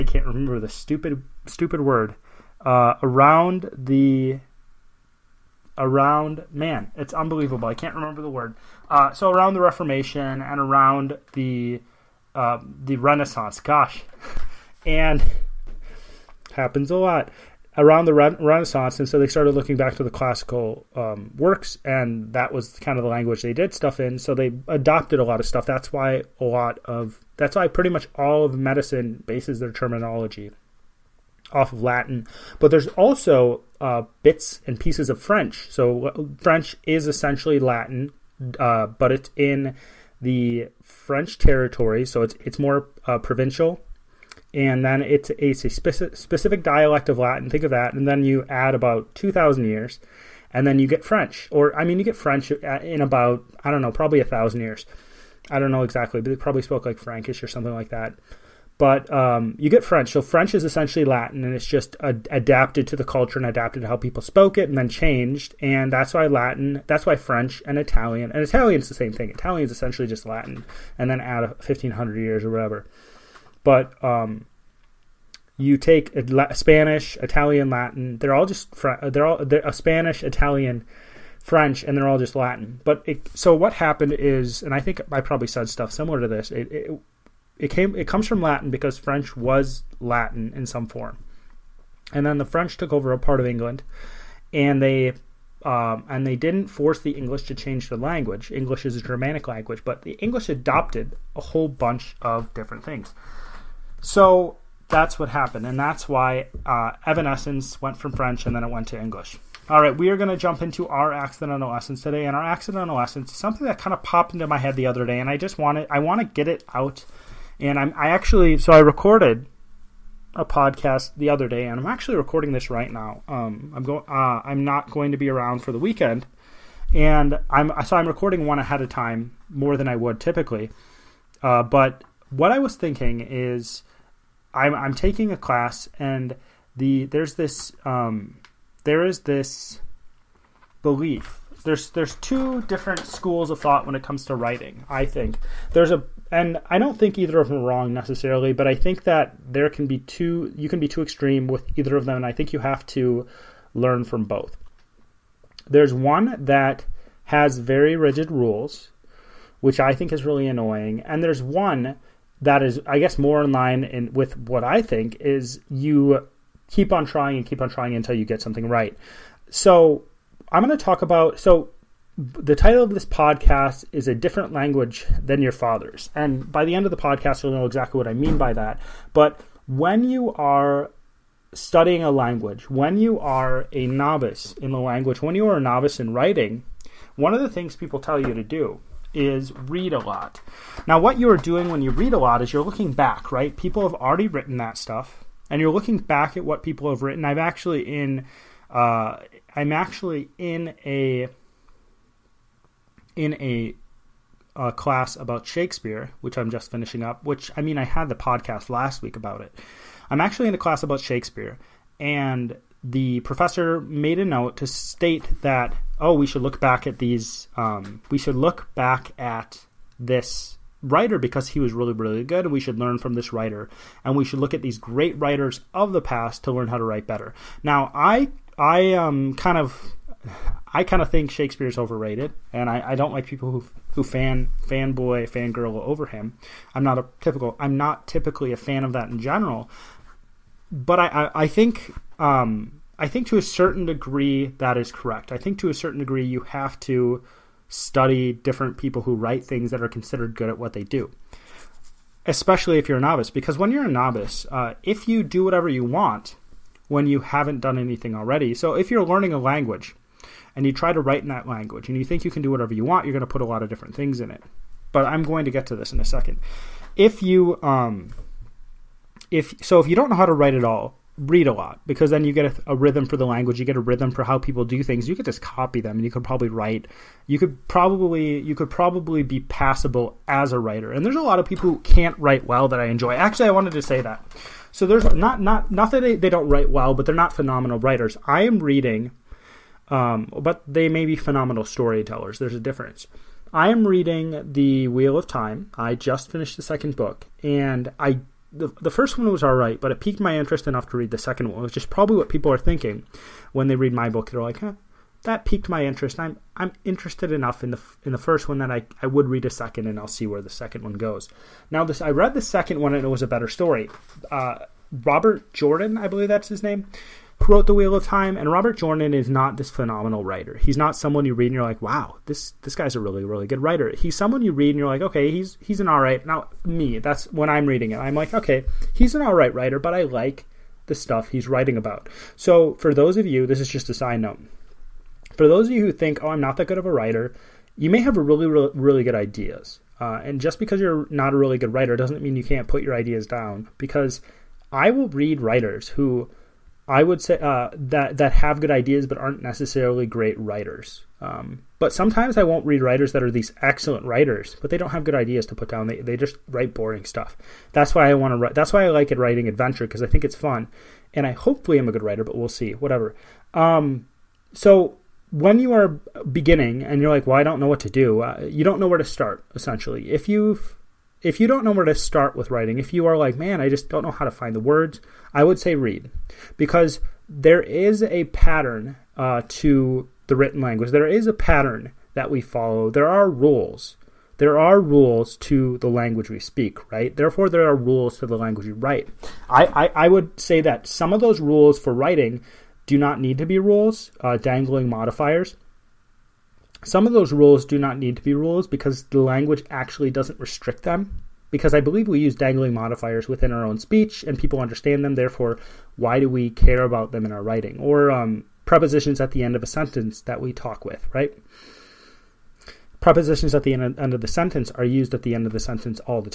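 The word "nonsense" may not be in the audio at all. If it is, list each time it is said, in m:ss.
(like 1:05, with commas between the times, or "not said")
not said.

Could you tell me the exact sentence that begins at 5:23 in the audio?
He's someone you read and you're like, okay, he's he's an all right.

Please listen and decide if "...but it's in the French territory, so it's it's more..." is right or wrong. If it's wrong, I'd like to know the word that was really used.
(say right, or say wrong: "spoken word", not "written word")
right.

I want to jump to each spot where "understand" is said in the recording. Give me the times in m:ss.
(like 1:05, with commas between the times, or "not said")
6:44.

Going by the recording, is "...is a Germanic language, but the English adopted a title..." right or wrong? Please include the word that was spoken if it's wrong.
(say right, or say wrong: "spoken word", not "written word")
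wrong: "whole", not "title".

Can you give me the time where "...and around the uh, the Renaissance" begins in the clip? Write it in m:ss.
0:10.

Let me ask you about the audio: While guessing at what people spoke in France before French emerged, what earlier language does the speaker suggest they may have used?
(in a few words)
Frankish.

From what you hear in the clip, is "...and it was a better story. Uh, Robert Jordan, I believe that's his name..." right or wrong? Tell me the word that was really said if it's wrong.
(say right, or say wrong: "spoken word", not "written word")
right.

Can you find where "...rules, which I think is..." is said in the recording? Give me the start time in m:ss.
2:38.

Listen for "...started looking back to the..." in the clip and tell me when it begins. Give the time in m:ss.
0:19.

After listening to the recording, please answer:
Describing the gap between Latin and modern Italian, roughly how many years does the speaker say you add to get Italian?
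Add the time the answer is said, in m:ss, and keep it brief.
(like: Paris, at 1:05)
1500, at 1:11.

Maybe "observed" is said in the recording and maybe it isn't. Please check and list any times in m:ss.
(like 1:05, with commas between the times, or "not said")
not said.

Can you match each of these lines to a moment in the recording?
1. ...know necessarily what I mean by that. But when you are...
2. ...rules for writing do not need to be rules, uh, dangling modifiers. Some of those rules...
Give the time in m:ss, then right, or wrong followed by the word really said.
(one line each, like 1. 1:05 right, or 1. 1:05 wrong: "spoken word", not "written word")
1. 2:57 wrong: "exactly", not "necessarily"
2. 6:31 right.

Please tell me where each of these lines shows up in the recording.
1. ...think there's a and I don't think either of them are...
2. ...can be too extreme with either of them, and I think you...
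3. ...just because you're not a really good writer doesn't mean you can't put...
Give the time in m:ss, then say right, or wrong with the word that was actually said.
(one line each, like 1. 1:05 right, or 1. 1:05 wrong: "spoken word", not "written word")
1. 2:25 right
2. 2:30 right
3. 5:40 right.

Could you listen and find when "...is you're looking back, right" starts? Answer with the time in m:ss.
3:12.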